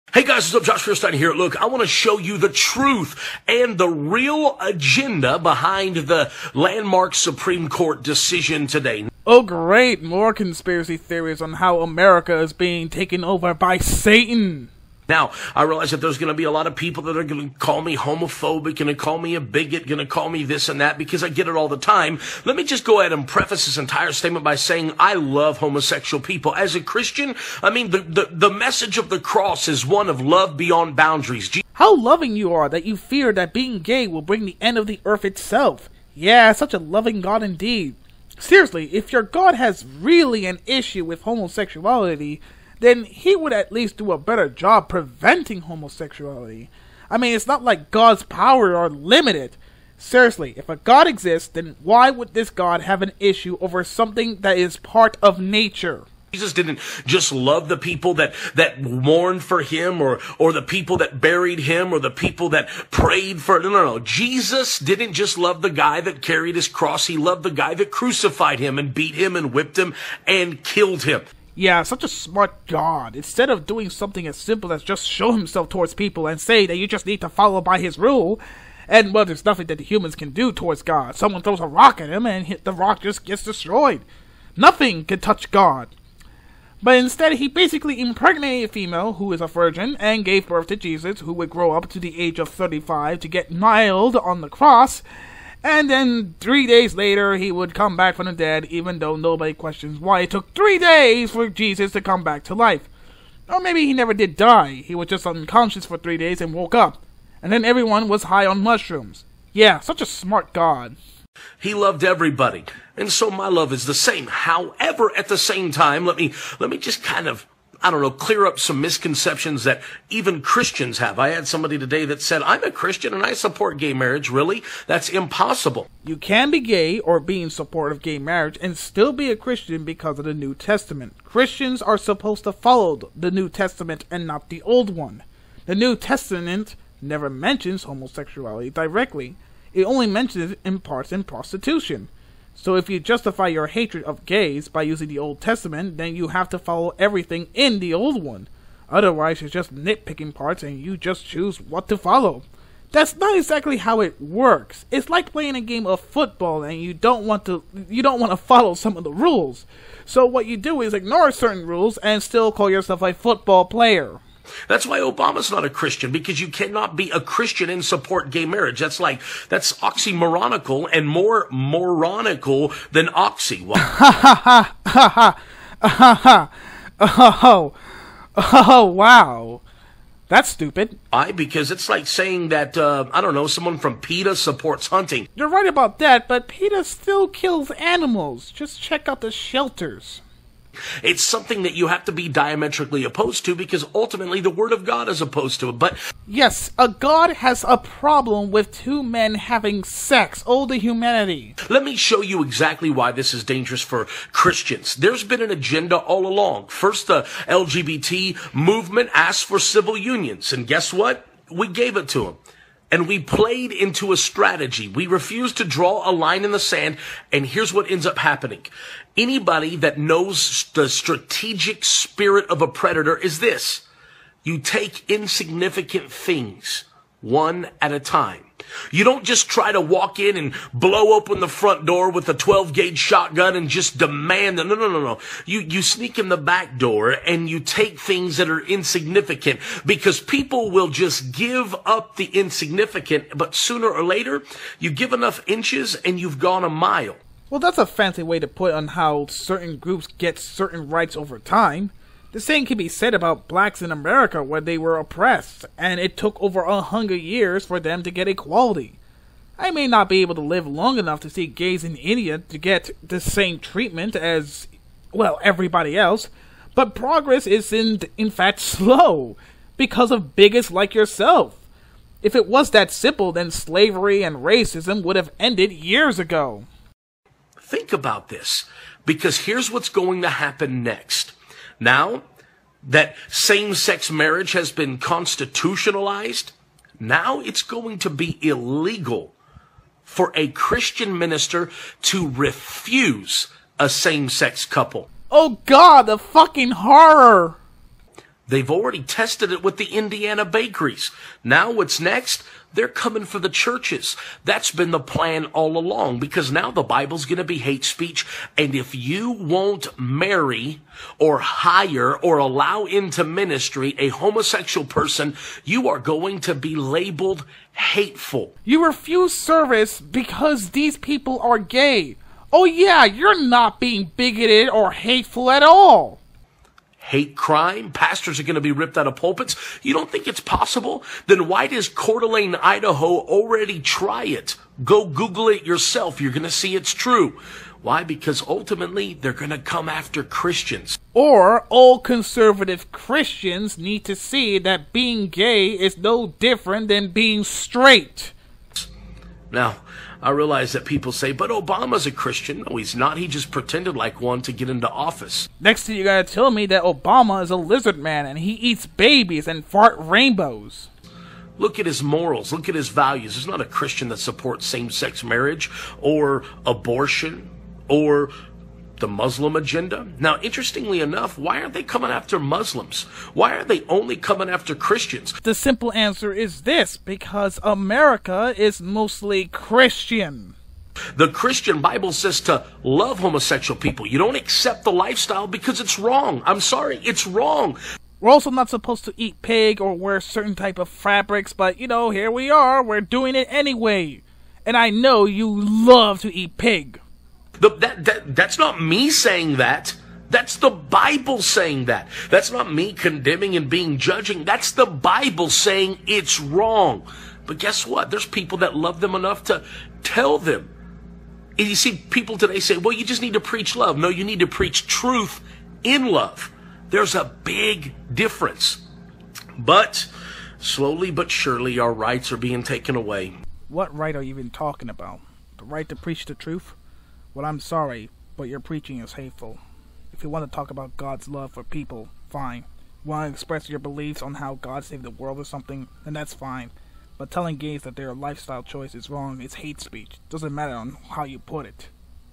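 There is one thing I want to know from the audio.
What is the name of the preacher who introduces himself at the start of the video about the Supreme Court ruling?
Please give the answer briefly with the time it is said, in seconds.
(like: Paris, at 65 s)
Josh Feuerstein, at 0 s.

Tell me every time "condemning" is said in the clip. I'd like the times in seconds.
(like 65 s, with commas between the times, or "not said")
402 s.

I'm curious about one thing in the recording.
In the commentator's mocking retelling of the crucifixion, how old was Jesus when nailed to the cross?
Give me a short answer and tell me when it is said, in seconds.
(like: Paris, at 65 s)
35, at 92 s.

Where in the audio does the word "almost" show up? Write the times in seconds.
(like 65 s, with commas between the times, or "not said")
not said.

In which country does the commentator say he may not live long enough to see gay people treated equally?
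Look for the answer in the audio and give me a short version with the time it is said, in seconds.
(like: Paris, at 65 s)
India, at 261 s.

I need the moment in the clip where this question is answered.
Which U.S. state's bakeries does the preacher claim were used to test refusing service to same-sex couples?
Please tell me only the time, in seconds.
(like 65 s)
299 s.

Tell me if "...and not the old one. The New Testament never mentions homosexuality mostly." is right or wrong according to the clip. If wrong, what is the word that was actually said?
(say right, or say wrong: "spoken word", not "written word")
wrong: "directly", not "mostly".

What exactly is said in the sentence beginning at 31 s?
how loving you are that you fear that being gay will bring the end of the earth itself.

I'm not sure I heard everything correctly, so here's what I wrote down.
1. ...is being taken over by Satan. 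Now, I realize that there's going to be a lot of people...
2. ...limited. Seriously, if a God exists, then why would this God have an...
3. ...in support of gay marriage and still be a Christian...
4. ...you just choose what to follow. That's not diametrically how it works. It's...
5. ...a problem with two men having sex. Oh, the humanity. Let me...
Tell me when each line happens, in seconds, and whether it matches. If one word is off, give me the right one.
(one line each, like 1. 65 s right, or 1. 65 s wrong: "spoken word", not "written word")
1. 12 s right
2. 48 s right
3. 127 s right
4. 150 s wrong: "exactly", not "diametrically"
5. 197 s right.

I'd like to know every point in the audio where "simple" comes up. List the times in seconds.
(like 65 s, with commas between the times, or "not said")
74 s, 272 s, 375 s.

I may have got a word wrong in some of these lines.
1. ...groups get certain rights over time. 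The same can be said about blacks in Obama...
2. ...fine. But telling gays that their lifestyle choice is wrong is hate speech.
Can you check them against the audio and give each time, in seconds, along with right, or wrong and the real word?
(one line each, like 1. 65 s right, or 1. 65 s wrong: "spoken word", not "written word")
1. 249 s wrong: "America", not "Obama"
2. 436 s right.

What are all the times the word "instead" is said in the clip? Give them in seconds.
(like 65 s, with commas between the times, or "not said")
73 s, 86 s.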